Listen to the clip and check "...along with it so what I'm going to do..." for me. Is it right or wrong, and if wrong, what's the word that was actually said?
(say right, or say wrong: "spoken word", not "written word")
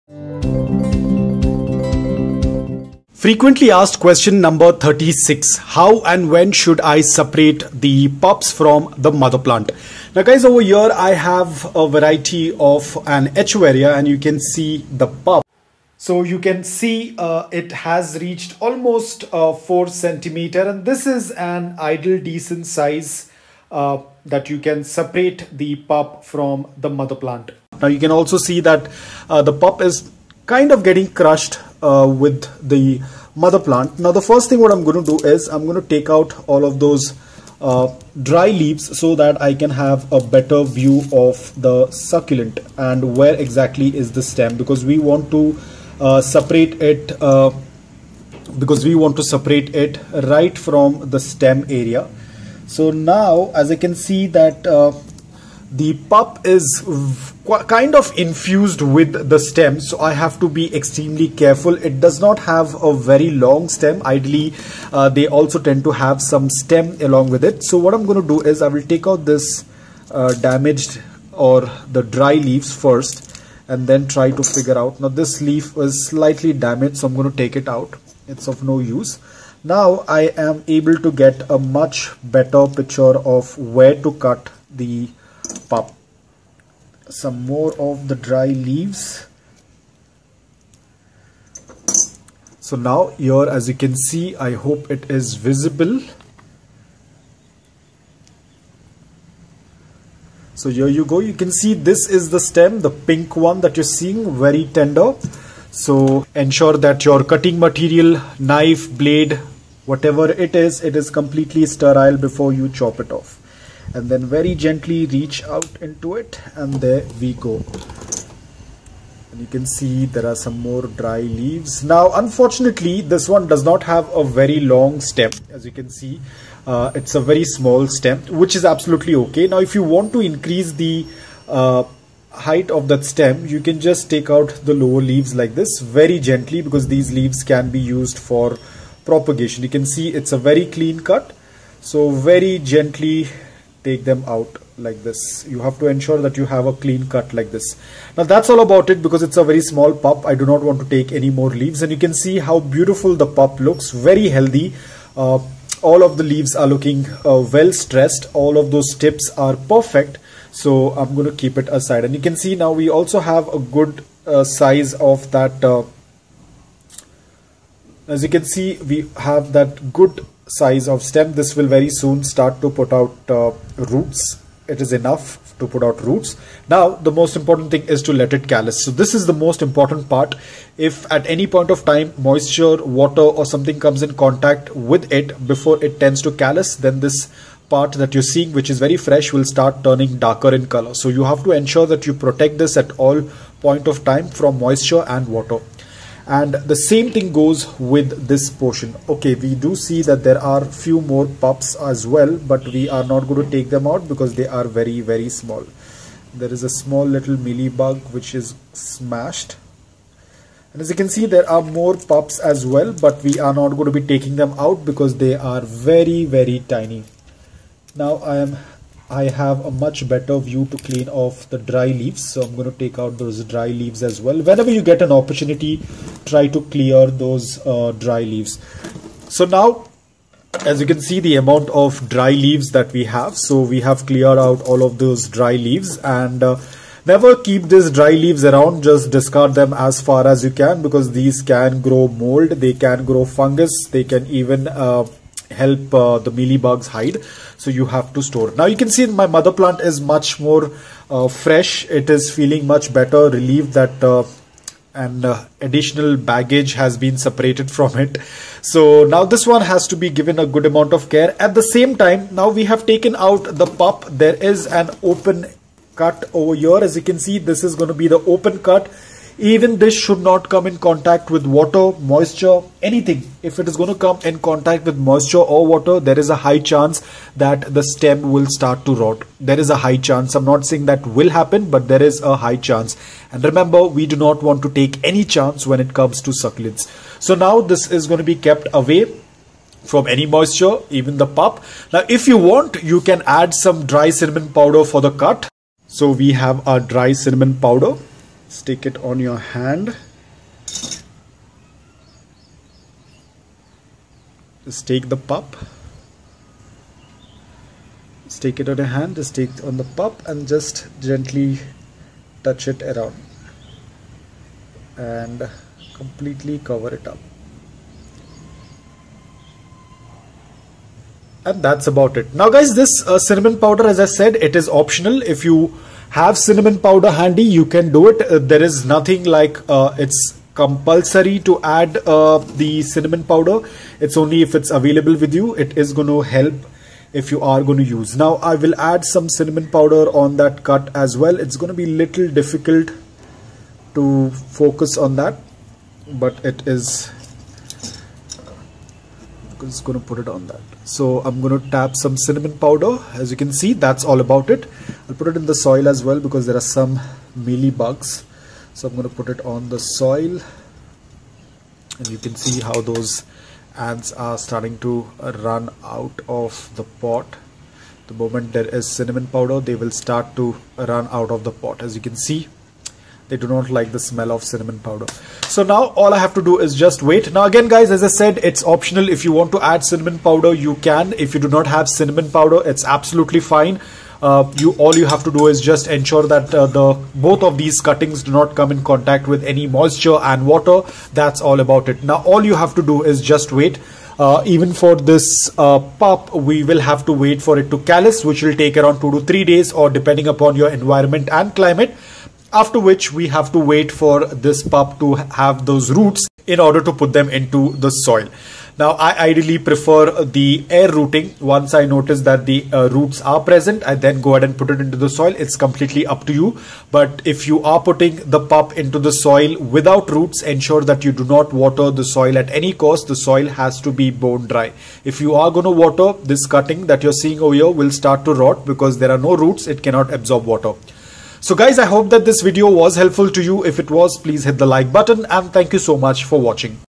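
right.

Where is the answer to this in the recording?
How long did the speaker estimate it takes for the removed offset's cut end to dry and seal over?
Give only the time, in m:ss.
6:39.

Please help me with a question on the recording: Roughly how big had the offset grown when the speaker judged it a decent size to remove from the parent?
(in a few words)
4 centimeters.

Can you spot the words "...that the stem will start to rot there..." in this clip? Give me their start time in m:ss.
4:37.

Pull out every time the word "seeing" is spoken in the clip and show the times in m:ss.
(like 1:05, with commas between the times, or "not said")
1:43, 3:08, 7:07.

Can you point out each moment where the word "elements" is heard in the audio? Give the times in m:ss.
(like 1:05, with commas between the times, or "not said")
not said.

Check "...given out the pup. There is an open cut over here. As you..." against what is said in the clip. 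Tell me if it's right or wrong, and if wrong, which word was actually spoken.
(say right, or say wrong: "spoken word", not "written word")
wrong: "taken", not "given".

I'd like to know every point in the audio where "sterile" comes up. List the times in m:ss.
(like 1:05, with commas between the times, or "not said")
1:51.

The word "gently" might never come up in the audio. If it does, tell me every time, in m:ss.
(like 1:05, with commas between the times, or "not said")
1:54, 2:16, 2:22, 5:10.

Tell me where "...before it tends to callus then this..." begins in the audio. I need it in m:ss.
3:05.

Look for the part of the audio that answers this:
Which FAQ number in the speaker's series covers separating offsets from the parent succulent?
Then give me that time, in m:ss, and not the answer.
0:04.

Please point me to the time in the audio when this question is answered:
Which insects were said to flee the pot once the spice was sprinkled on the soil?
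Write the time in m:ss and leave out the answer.
6:03.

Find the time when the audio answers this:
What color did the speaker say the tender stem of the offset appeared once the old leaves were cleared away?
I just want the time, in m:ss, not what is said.
1:42.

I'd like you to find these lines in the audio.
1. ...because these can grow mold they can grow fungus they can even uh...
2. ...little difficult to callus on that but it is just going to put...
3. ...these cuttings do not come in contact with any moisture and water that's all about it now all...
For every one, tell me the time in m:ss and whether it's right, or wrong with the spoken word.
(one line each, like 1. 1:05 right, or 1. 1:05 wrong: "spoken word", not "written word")
1. 4:00 right
2. 5:41 wrong: "focus", not "callus"
3. 6:27 right.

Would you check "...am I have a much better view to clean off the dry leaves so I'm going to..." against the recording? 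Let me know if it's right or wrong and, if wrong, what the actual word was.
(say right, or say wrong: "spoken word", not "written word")
right.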